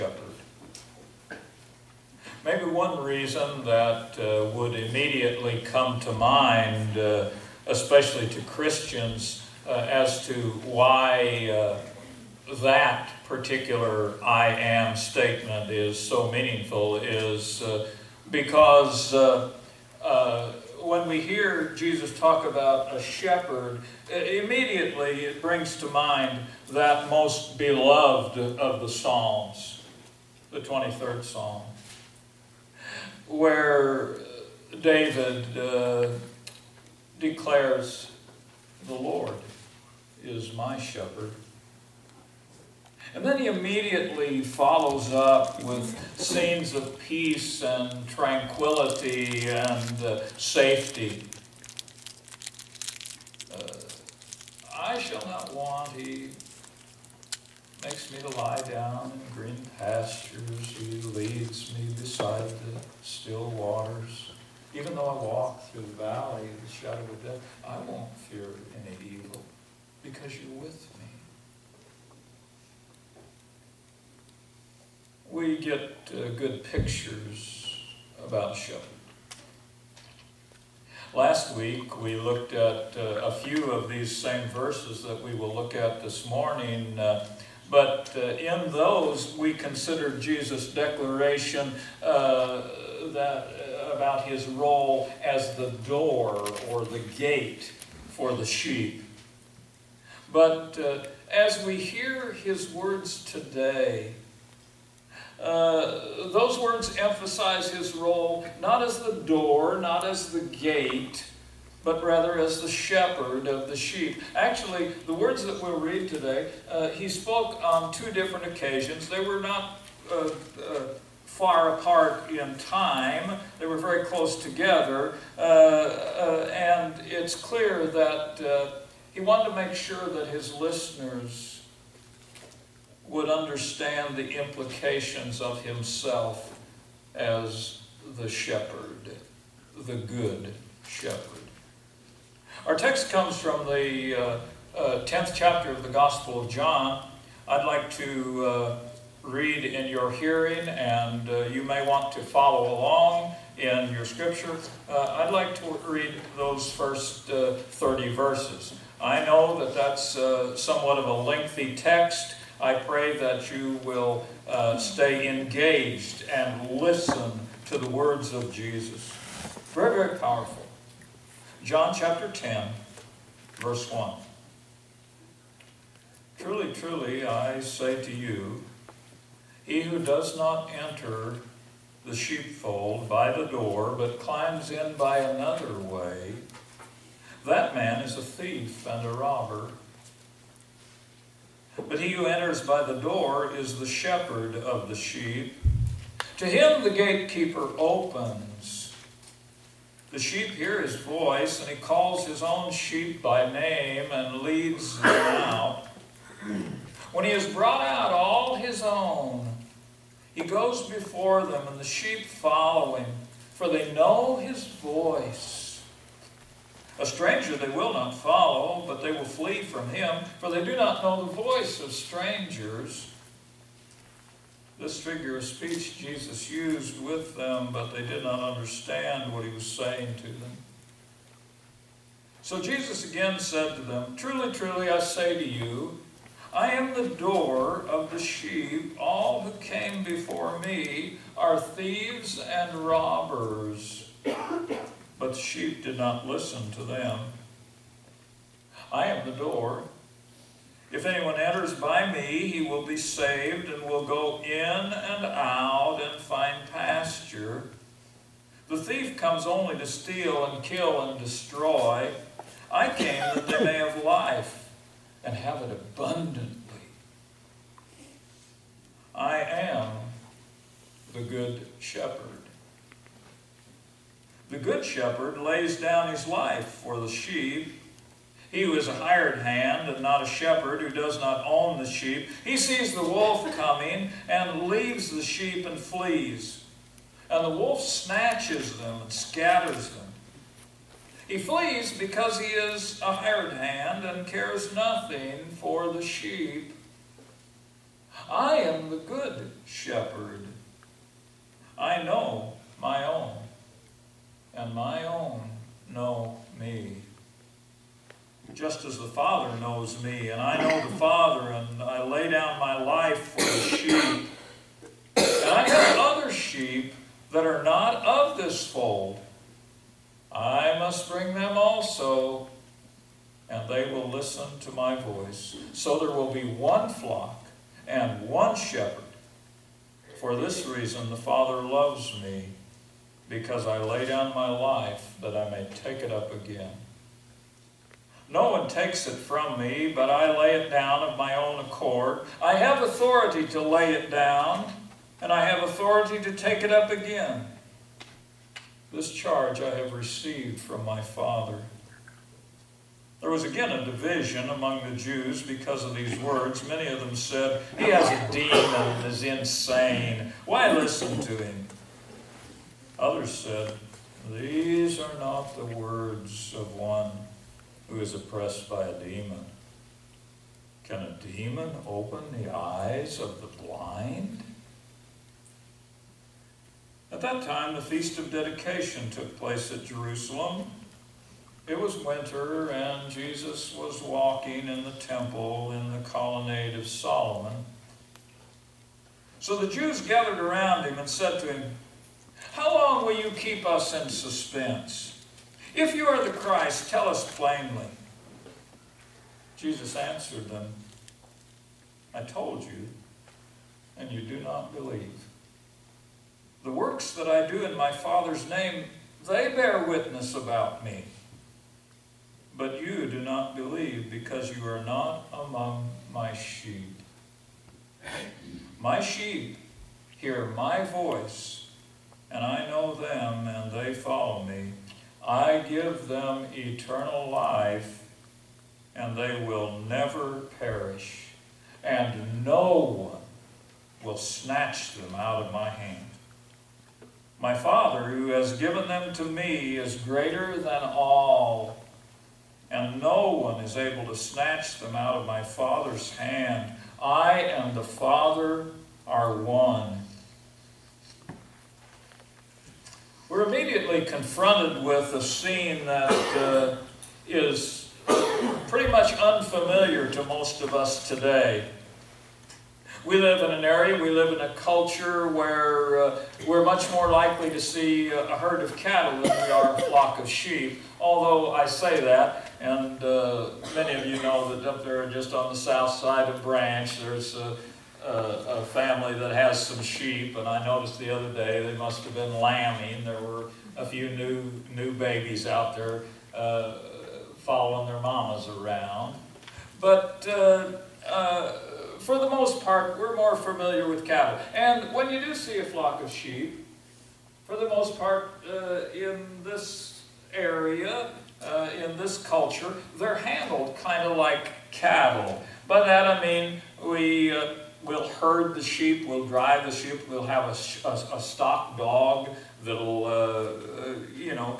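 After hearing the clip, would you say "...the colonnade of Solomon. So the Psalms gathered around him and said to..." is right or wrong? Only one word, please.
wrong.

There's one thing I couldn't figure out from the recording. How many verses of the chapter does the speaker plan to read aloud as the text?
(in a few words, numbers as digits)
30.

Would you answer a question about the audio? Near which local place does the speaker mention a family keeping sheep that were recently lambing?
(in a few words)
Branch.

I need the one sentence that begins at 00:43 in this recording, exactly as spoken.
And then he immediately follows up with scenes of peace and tranquility and uh, safety.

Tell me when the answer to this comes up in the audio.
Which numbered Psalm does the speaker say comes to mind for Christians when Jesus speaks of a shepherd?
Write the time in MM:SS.
00:30.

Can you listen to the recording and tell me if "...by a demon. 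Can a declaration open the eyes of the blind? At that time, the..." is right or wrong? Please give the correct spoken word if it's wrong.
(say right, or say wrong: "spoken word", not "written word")
wrong: "demon", not "declaration".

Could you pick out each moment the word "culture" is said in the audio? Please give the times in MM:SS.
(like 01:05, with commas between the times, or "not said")
07:44, 08:22.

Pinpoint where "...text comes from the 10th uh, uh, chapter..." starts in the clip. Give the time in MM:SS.
02:22.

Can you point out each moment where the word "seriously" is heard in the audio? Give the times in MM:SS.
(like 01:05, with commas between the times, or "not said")
not said.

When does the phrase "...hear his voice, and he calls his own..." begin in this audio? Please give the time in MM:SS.
03:20.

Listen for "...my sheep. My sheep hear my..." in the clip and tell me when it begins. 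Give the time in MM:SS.
06:56.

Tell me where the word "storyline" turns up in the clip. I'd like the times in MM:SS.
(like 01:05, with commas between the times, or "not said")
not said.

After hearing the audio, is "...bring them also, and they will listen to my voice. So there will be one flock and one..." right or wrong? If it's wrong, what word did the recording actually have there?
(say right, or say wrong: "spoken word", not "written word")
right.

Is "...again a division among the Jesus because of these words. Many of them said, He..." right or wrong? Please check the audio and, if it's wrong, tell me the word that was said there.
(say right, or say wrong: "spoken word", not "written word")
wrong: "Jews", not "Jesus".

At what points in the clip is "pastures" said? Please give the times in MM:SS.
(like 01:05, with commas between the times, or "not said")
00:59, 04:16.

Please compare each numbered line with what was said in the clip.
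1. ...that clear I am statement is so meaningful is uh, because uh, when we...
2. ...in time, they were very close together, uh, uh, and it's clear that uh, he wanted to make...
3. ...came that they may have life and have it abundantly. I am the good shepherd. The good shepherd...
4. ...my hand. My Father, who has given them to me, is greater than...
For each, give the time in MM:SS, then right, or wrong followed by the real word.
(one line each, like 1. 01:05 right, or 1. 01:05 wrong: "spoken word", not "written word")
1. 00:12 wrong: "particular", not "clear"
2. 02:02 right
3. 04:22 right
4. 07:15 right.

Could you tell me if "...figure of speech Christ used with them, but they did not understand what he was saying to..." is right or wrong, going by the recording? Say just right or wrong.
wrong.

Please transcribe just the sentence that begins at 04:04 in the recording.
But the sheep did not listen to them.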